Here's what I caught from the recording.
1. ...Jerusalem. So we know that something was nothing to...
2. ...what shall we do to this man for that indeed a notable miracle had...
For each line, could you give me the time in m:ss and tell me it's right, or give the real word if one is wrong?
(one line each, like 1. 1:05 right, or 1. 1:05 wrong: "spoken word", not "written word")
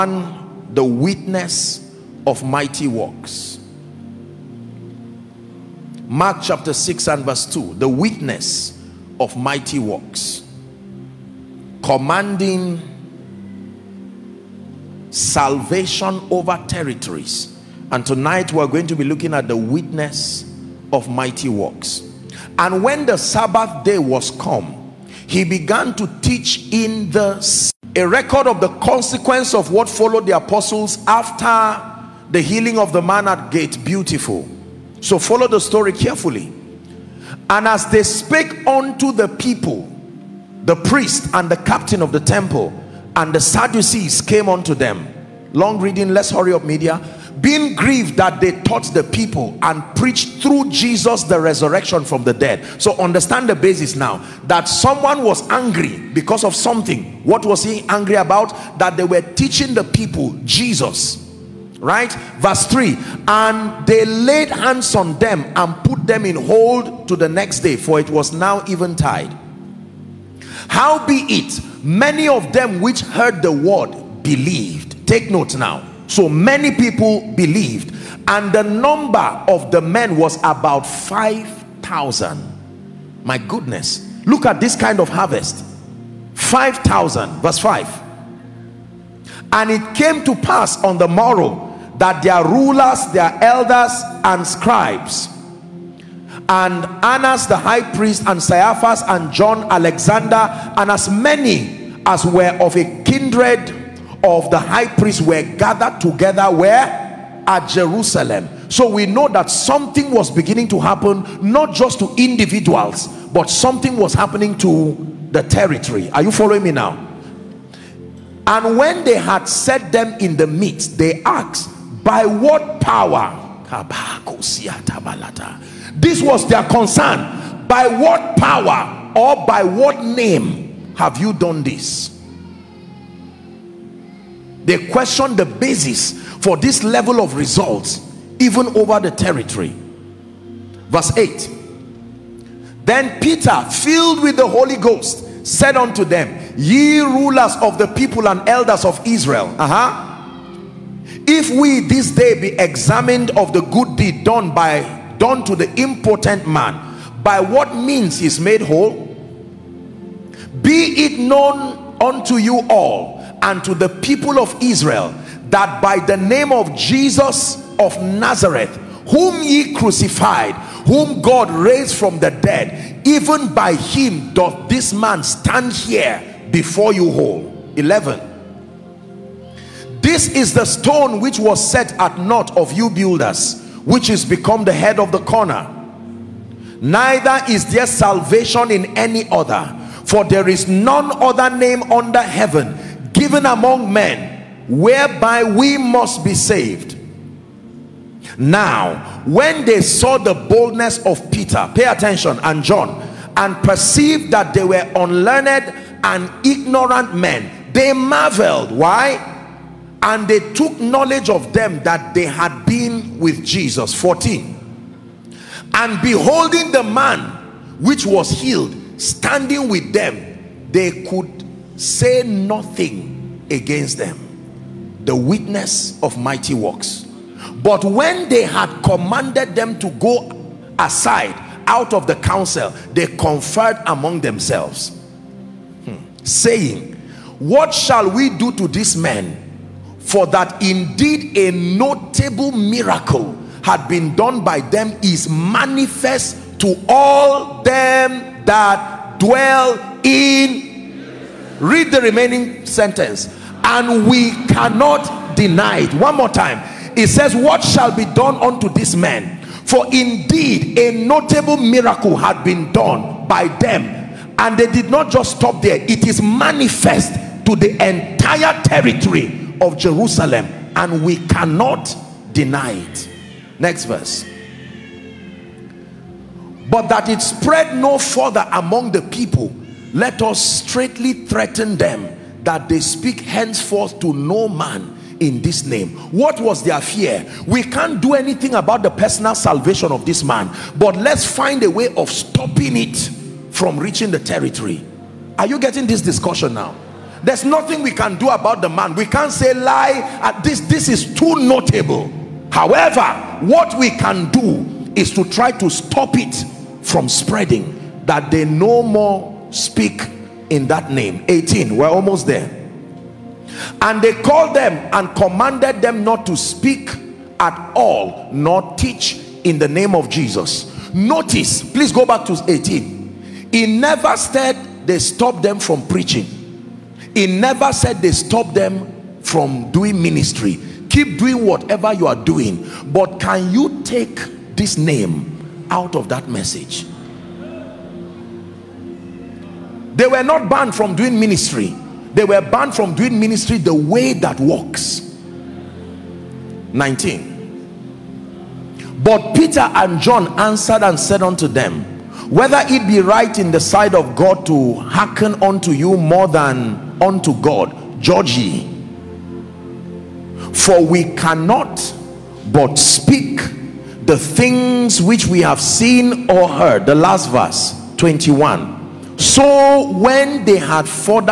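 1. 1:47 wrong: "beginning", not "nothing"
2. 3:57 right.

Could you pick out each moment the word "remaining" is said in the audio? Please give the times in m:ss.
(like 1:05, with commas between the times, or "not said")
4:12.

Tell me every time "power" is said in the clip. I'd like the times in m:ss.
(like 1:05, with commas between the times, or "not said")
2:02, 2:08.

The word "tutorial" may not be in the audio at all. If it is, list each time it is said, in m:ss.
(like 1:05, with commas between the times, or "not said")
not said.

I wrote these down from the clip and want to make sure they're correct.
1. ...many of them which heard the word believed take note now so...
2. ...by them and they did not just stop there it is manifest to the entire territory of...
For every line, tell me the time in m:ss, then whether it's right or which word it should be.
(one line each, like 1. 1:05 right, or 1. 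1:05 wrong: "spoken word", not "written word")
1. 1:11 right
2. 4:23 right.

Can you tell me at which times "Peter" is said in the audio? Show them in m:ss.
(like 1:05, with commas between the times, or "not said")
2:23, 3:21, 5:49.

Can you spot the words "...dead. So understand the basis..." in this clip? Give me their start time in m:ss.
0:52.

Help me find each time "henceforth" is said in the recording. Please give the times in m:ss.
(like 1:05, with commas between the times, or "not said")
4:43.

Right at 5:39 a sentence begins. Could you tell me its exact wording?
They were not banned from doing ministry.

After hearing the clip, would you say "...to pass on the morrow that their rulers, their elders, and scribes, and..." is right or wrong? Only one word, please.
right.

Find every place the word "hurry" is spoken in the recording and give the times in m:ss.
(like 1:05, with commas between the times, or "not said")
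0:46.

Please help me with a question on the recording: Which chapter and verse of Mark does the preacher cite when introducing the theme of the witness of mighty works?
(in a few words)
Mark 6:2.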